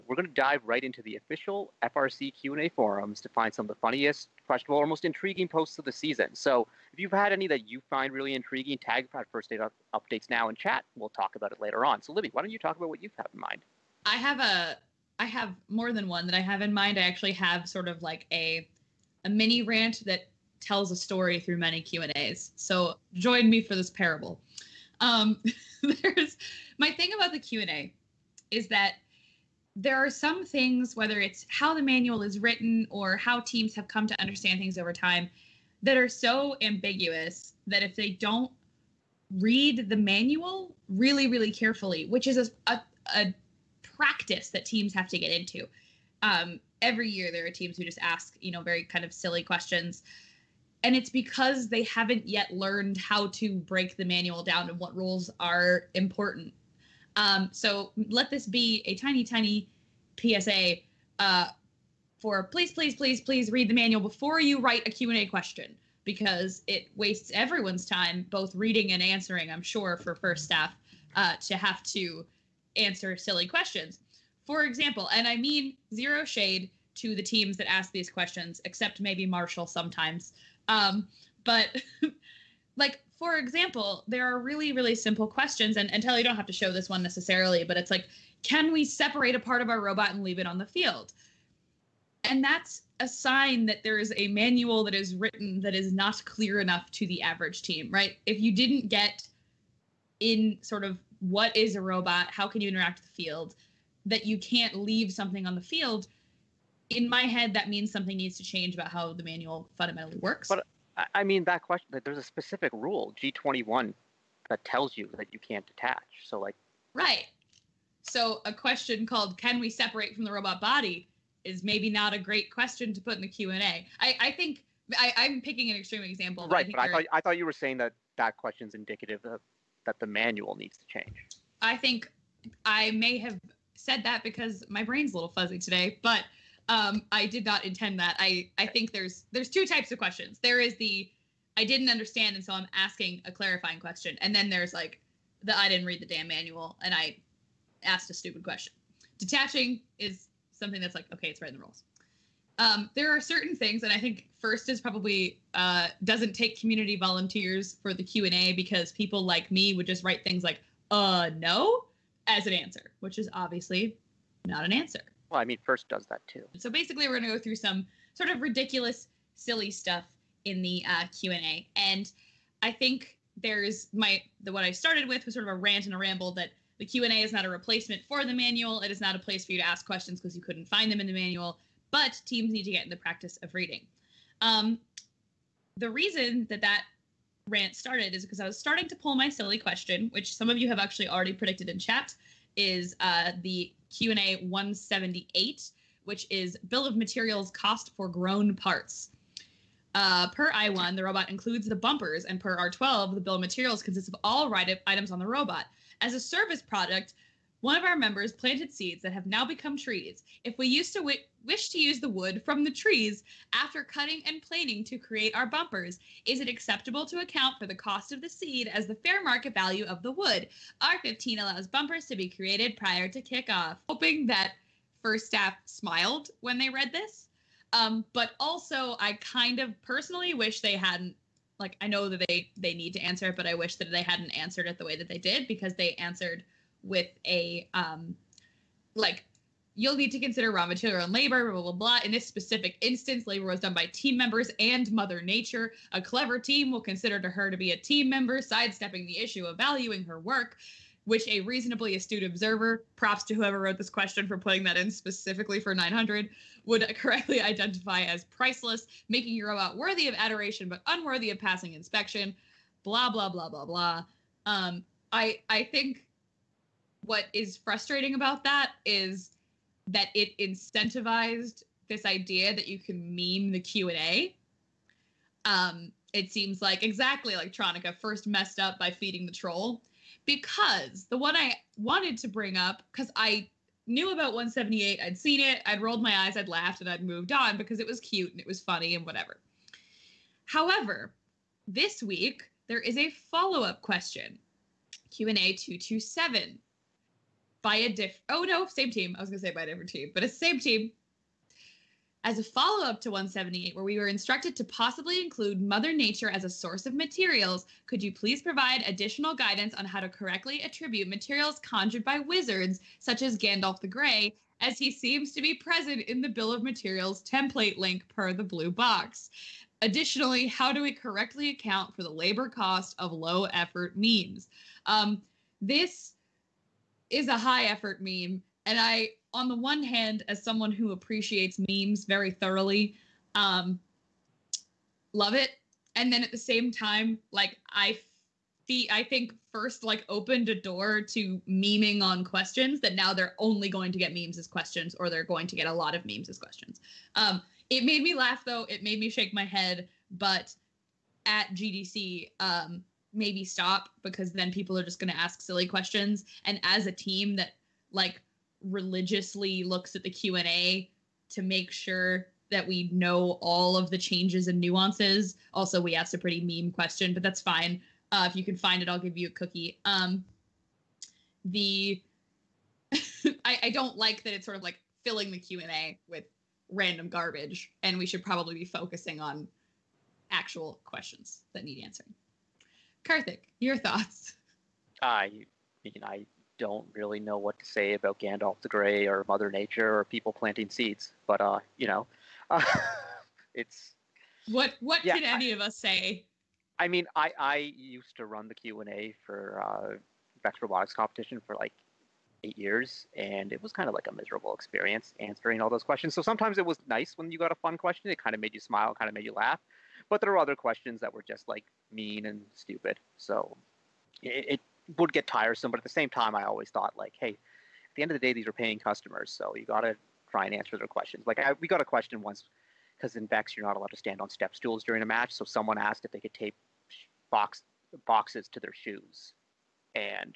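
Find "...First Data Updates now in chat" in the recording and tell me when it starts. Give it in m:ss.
0:09.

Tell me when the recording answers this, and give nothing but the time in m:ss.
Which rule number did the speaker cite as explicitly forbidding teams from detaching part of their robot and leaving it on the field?
1:53.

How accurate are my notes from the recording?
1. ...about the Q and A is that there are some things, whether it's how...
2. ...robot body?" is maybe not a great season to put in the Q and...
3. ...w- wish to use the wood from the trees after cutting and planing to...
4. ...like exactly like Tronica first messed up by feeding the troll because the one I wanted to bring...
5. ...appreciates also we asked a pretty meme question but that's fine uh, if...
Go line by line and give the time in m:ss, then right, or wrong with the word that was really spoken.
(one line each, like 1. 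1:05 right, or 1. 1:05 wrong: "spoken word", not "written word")
1. 0:27 right
2. 2:00 wrong: "question", not "season"
3. 3:30 right
4. 4:36 right
5. 6:04 wrong: "nuances", not "appreciates".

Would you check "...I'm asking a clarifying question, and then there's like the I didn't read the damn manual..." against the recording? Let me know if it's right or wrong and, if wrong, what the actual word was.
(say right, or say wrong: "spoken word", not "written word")
right.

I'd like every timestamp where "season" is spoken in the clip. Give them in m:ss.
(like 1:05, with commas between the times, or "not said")
0:05.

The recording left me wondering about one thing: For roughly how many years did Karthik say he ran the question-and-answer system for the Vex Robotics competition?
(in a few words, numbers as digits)
8.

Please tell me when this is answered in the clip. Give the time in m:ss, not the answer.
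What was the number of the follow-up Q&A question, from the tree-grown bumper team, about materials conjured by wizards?
4:55.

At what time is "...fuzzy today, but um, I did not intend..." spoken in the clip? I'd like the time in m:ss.
2:15.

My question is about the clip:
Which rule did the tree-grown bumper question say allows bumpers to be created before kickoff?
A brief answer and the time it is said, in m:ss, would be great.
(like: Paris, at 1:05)
R15, at 3:40.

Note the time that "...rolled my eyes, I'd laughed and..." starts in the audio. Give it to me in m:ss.
4:45.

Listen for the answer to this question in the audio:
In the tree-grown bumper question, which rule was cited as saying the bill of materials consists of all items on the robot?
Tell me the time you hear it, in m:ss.
3:22.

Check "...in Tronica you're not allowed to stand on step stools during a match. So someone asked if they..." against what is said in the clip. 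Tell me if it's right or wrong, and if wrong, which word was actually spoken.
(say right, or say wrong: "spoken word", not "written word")
wrong: "Vex", not "Tronica".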